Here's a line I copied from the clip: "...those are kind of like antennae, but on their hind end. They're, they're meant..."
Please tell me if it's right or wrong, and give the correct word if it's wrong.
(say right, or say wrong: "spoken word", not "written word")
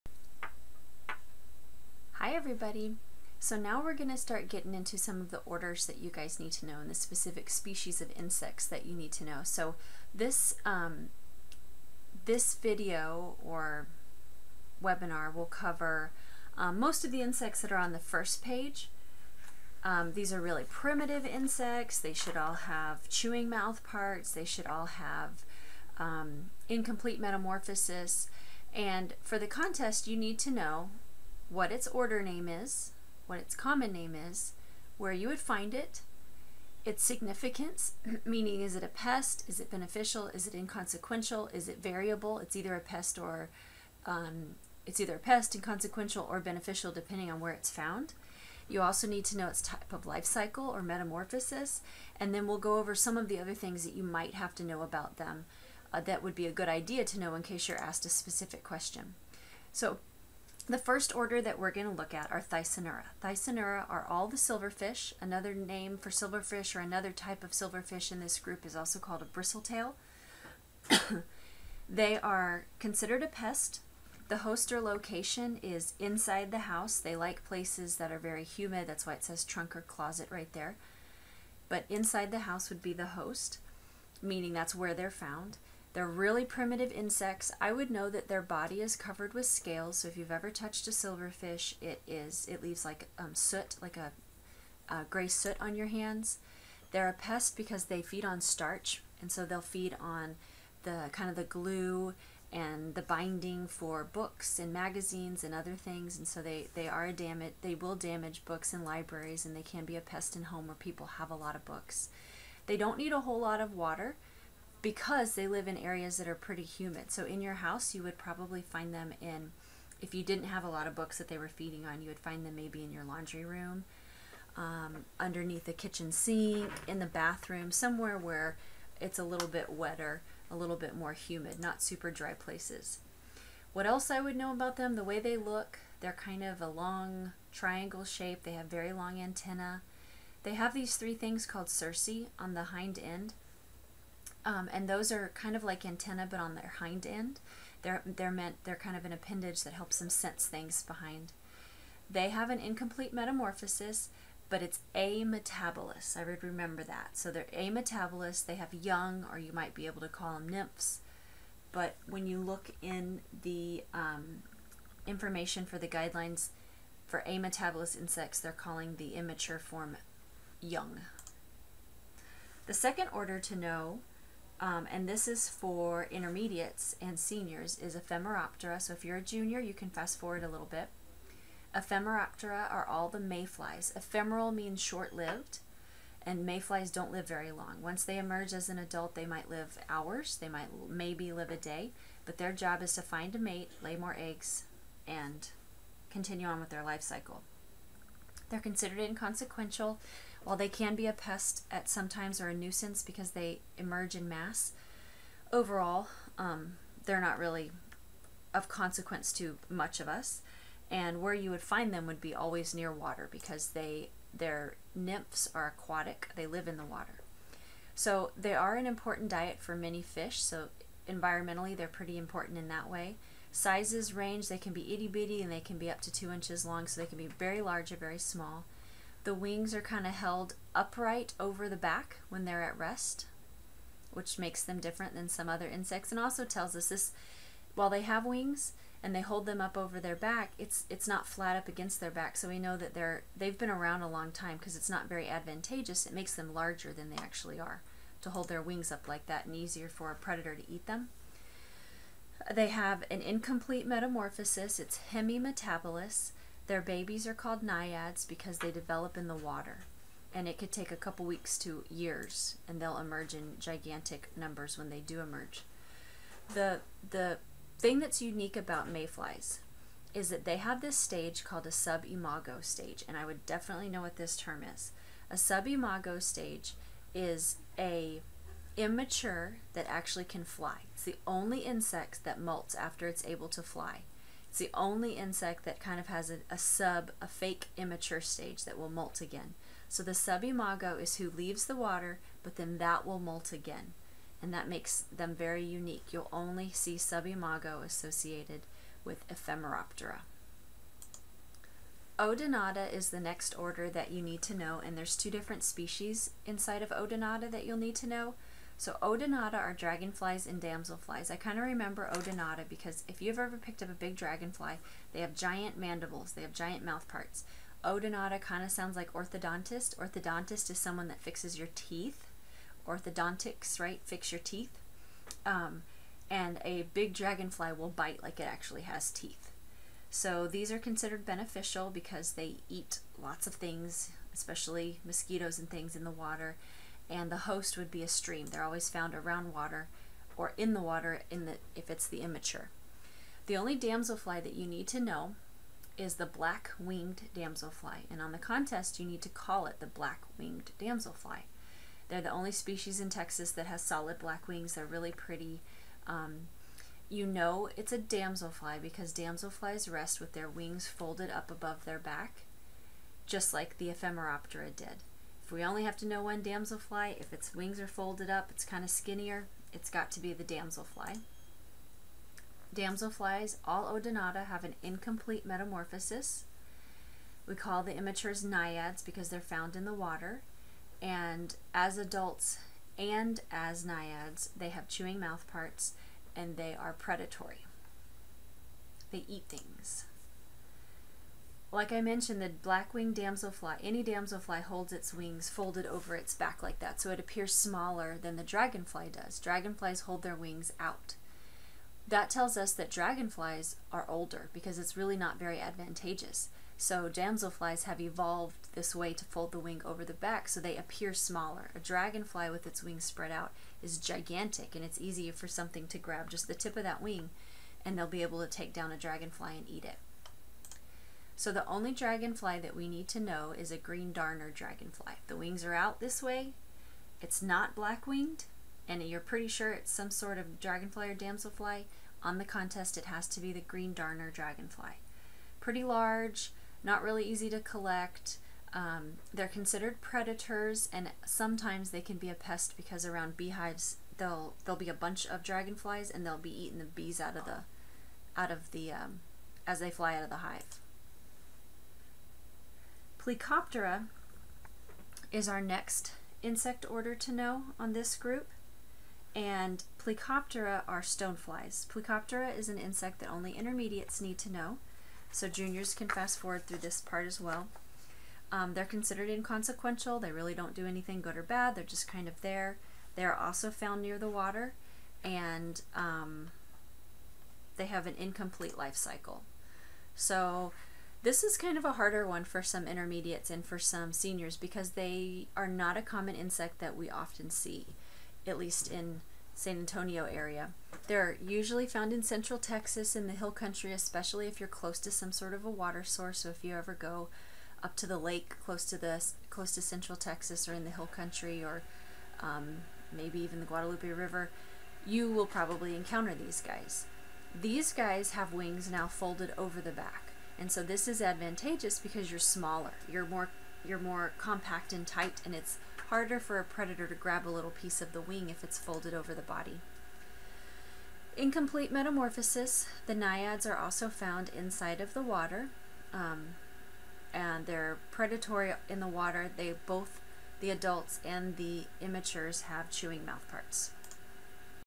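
right.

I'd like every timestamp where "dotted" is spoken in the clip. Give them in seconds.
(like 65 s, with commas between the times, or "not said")
not said.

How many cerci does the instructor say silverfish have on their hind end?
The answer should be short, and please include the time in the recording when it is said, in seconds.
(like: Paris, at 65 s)
3, at 140 s.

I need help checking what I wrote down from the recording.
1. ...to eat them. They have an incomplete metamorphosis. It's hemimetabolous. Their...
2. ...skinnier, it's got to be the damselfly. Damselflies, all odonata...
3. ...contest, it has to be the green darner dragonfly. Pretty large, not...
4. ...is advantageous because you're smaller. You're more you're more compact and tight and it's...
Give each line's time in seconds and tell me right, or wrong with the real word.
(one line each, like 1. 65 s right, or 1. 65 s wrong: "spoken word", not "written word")
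1. 250 s right
2. 368 s right
3. 432 s right
4. 511 s right.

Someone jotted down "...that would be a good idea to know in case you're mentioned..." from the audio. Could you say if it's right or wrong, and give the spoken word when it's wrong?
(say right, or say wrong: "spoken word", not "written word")
wrong: "asked", not "mentioned".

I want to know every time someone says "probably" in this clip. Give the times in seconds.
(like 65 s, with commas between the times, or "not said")
118 s, 505 s.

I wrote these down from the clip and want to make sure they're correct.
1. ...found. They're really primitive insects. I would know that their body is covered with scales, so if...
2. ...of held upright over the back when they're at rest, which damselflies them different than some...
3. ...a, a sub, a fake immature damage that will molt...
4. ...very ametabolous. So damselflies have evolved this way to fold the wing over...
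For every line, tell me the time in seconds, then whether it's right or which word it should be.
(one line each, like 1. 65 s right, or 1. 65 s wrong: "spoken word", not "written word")
1. 85 s right
2. 230 s wrong: "makes", not "damselflies"
3. 286 s wrong: "stage", not "damage"
4. 405 s wrong: "advantageous", not "ametabolous".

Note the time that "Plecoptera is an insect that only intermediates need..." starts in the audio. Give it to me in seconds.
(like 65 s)
461 s.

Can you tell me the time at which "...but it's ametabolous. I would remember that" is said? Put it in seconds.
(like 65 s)
154 s.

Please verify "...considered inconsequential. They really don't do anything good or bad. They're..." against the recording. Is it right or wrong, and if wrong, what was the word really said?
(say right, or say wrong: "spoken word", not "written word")
right.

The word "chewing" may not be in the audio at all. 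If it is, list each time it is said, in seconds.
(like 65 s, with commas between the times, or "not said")
23 s, 384 s, 532 s.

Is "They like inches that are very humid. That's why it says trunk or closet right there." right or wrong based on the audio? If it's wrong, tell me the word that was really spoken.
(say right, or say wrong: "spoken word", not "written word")
wrong: "places", not "inches".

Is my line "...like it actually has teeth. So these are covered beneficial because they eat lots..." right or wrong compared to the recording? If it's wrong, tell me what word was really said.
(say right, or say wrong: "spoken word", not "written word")
wrong: "considered", not "covered".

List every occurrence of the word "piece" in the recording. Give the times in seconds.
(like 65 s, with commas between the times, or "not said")
517 s.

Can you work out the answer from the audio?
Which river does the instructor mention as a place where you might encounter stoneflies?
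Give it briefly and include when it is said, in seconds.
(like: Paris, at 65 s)
Guadalupe River, at 503 s.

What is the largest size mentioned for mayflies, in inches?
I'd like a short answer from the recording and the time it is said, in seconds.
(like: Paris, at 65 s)
2 inches, at 226 s.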